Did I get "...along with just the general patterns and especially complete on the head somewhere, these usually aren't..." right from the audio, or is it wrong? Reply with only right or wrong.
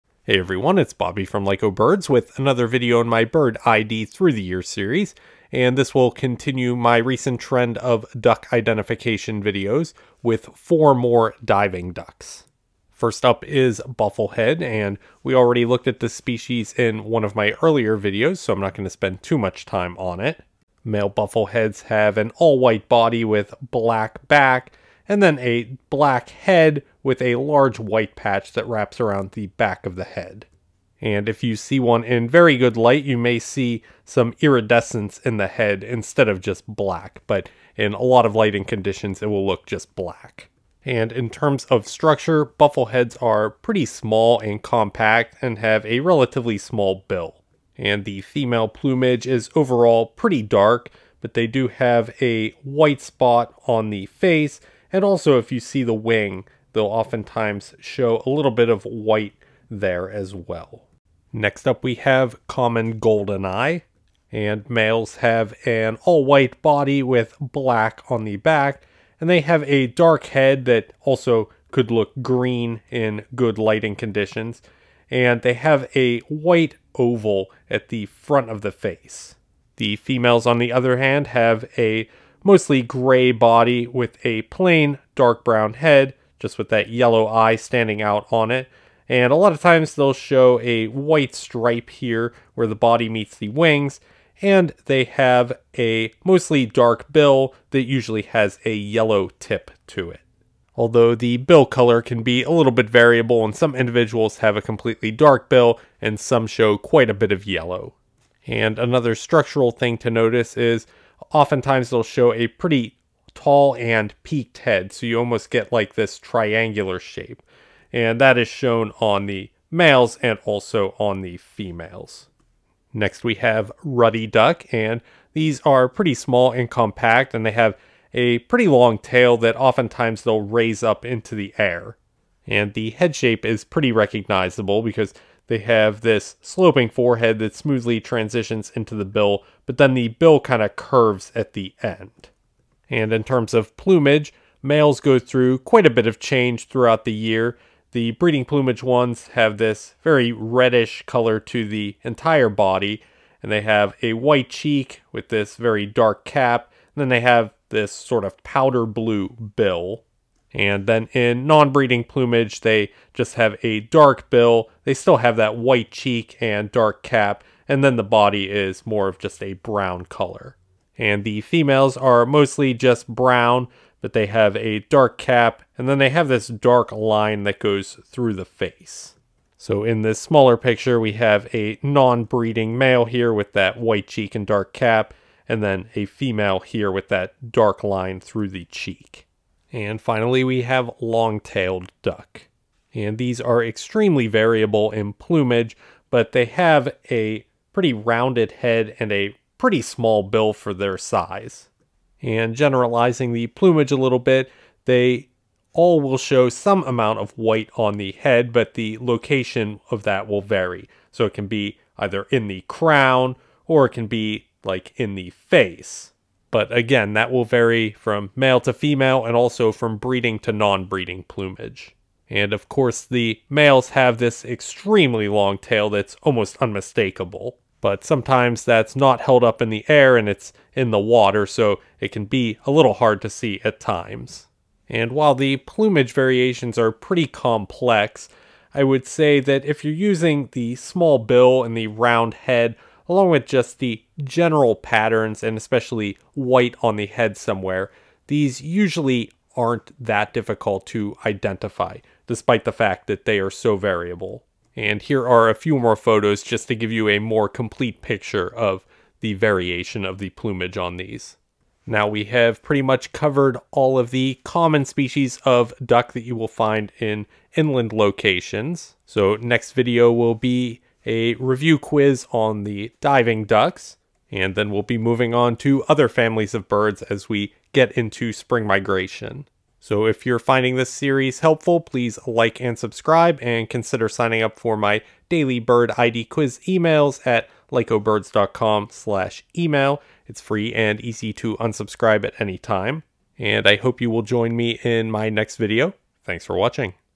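wrong.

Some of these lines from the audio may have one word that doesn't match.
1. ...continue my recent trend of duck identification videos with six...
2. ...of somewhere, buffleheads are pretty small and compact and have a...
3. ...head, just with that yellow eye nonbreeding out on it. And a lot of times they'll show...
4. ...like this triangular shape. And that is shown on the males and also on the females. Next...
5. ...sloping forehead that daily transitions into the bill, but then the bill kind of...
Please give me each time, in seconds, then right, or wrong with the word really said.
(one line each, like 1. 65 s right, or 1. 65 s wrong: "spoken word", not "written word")
1. 6 s wrong: "four", not "six"
2. 41 s wrong: "structure", not "somewhere"
3. 85 s wrong: "standing", not "nonbreeding"
4. 115 s right
5. 136 s wrong: "smoothly", not "daily".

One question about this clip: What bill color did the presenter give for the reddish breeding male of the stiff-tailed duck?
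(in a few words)
Powder blue.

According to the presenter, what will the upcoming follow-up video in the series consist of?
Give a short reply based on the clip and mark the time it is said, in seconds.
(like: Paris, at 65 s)
A review quiz, at 271 s.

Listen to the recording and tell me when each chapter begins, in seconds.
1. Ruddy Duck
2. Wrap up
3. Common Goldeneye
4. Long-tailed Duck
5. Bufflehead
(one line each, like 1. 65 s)
1. 122 s
2. 261 s
3. 60 s
4. 189 s
5. 13 s.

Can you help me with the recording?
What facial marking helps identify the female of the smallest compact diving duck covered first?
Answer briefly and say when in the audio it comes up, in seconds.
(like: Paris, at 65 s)
White spot, at 52 s.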